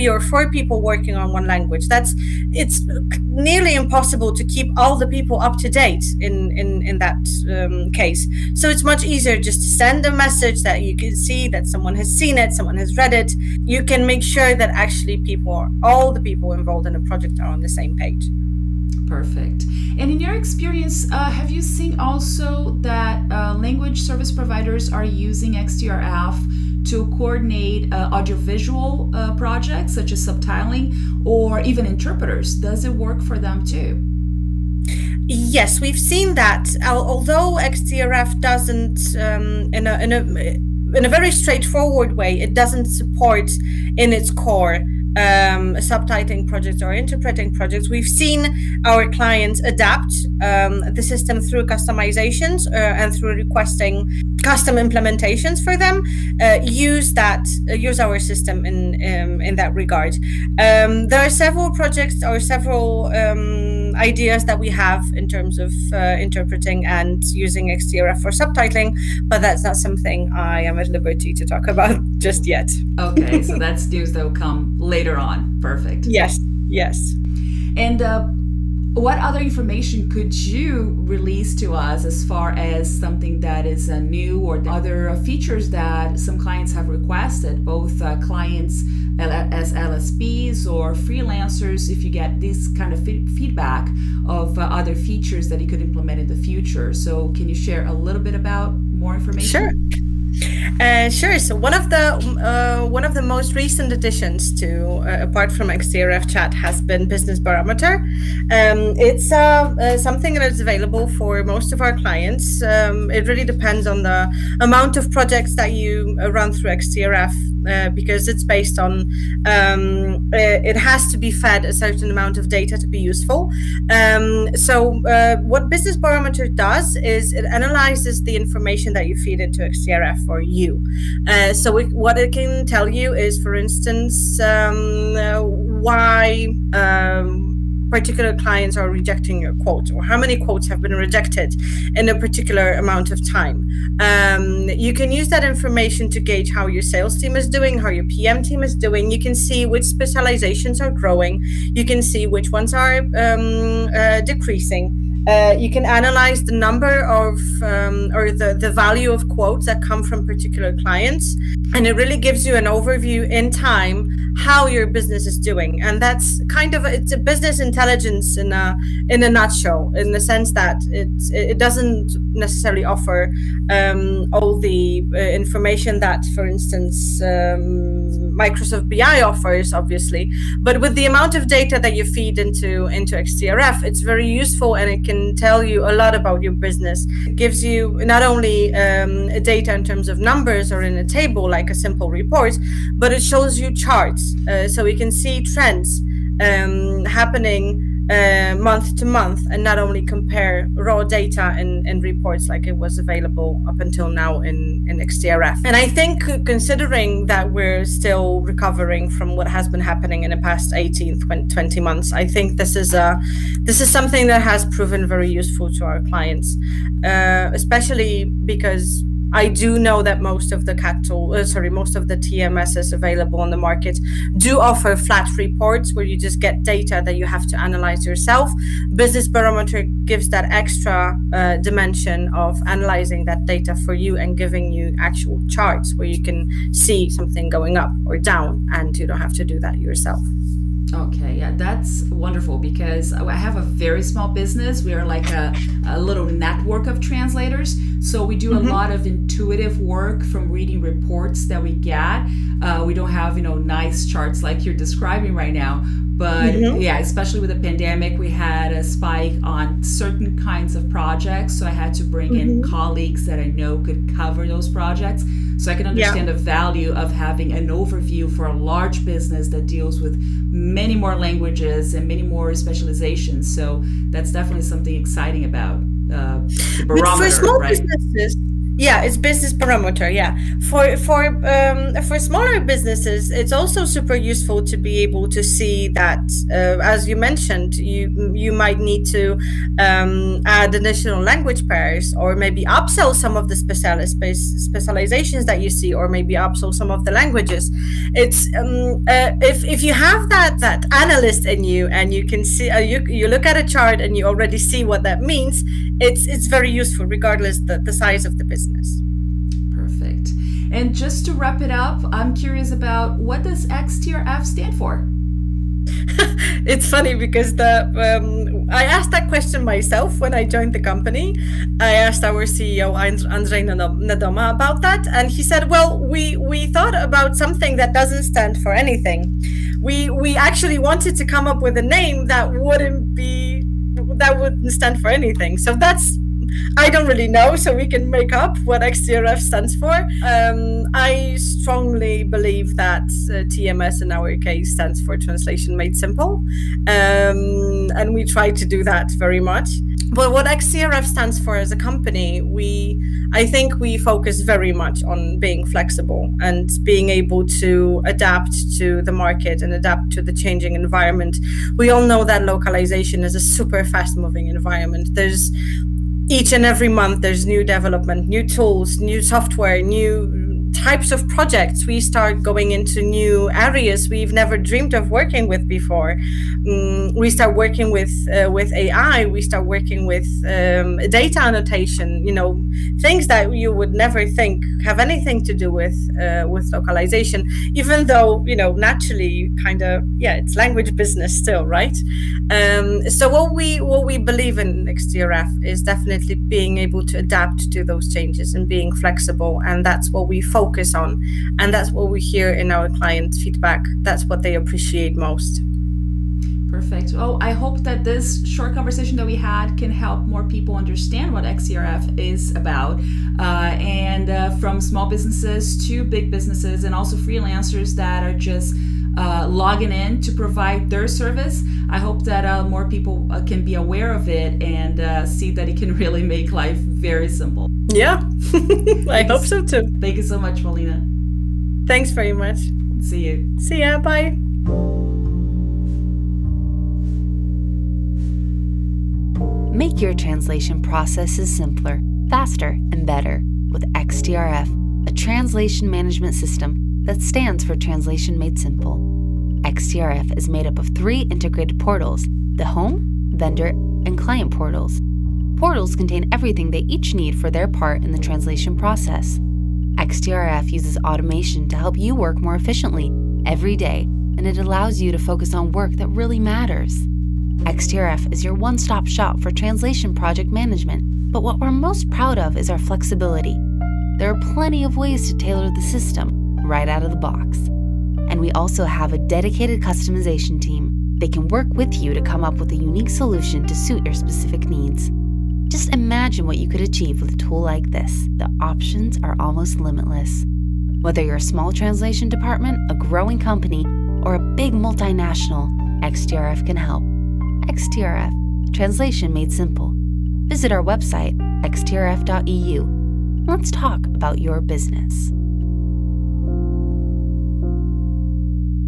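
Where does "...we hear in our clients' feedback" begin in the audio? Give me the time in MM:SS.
06:42.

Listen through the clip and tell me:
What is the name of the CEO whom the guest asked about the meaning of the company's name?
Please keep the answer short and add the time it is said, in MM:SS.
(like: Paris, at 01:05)
Andrei Nadoma, at 05:23.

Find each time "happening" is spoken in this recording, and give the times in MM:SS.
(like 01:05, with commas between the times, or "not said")
03:17, 03:29.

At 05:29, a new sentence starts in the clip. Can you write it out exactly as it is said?
We we actually wanted to come up with a name that wouldn't be that wouldn't stand for anything.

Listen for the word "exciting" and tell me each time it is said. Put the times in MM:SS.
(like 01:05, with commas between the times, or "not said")
04:34.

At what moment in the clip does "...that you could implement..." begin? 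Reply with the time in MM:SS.
01:35.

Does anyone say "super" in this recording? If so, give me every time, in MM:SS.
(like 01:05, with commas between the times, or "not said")
04:43, 06:03.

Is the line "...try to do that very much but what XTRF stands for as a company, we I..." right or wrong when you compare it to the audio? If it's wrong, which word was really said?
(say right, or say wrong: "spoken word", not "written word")
right.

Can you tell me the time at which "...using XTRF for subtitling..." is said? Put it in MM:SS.
01:07.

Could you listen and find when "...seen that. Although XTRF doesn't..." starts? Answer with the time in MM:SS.
00:35.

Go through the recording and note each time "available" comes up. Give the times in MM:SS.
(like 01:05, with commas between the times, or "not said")
01:50, 03:22, 03:42.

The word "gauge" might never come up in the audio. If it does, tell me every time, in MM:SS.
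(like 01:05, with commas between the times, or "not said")
02:26.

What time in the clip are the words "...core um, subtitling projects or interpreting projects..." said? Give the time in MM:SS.
00:44.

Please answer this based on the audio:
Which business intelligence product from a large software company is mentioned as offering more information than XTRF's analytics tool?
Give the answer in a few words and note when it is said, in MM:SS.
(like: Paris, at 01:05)
Microsoft BI, at 02:58.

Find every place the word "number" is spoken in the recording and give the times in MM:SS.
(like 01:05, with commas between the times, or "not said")
02:36, 03:10.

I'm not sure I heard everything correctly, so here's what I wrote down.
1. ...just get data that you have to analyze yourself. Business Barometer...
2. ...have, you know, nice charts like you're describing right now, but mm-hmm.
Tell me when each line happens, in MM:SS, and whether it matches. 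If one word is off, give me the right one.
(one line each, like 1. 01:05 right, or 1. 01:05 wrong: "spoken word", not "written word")
1. 03:46 right
2. 04:13 right.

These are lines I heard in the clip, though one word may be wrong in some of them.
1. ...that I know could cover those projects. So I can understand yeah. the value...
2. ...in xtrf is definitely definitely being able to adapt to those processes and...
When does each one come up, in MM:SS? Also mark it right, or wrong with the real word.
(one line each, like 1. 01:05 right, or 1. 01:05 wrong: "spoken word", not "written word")
1. 04:23 right
2. 06:34 wrong: "changes", not "processes".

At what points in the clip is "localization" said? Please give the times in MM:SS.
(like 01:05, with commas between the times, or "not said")
06:02, 06:26.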